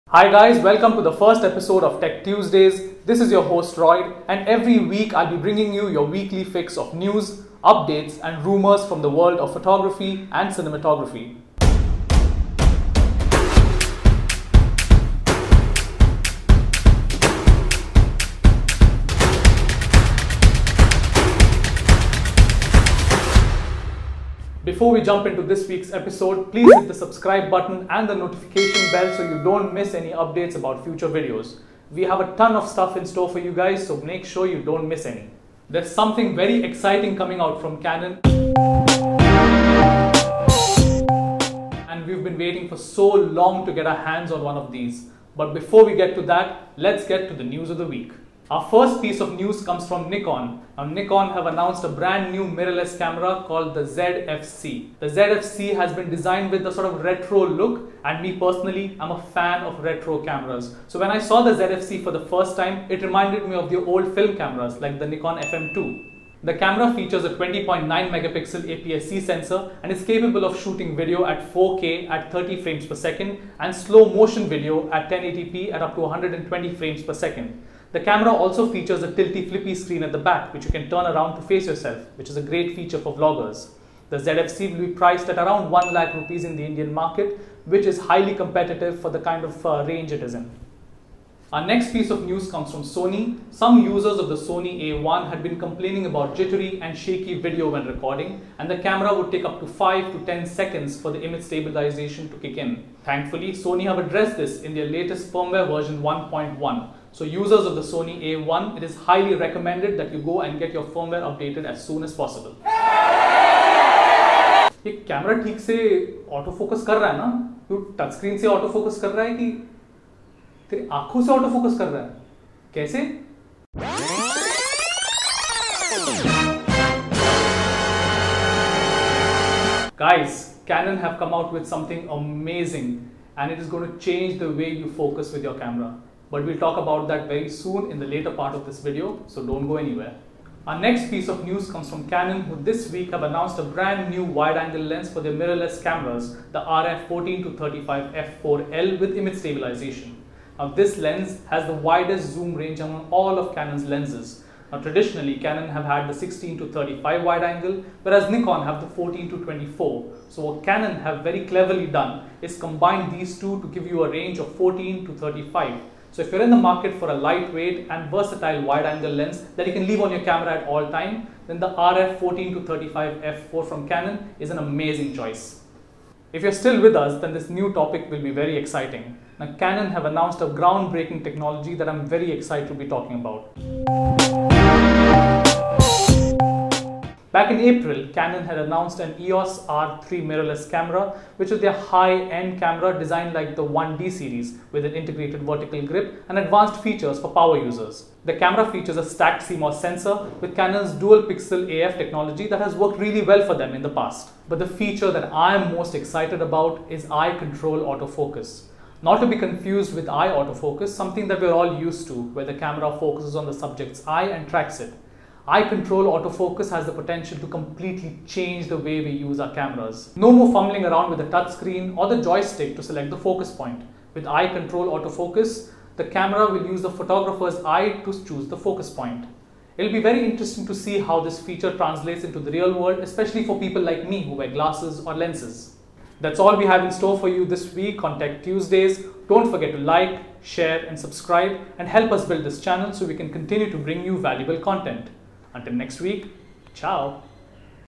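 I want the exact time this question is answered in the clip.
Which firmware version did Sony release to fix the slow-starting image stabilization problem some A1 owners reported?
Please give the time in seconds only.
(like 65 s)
105 s.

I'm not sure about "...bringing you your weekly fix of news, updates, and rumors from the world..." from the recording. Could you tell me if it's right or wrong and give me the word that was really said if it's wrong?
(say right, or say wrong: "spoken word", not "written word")
right.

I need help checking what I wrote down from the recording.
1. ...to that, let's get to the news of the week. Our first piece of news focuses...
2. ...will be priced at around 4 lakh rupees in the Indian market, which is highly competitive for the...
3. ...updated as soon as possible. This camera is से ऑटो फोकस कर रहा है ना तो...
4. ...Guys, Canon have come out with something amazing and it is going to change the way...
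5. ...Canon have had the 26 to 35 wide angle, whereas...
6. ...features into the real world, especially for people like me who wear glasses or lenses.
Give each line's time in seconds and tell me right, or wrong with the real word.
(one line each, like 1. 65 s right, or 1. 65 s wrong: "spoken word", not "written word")
1. 46 s wrong: "comes", not "focuses"
2. 84 s wrong: "1", not "4"
3. 111 s right
4. 130 s right
5. 155 s wrong: "16", not "26"
6. 231 s wrong: "translates", not "features".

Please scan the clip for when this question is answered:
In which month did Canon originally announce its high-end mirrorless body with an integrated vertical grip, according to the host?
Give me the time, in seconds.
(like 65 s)
187 s.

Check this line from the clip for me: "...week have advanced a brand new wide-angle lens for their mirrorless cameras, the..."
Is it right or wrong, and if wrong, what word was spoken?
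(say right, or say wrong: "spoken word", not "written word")
wrong: "announced", not "advanced".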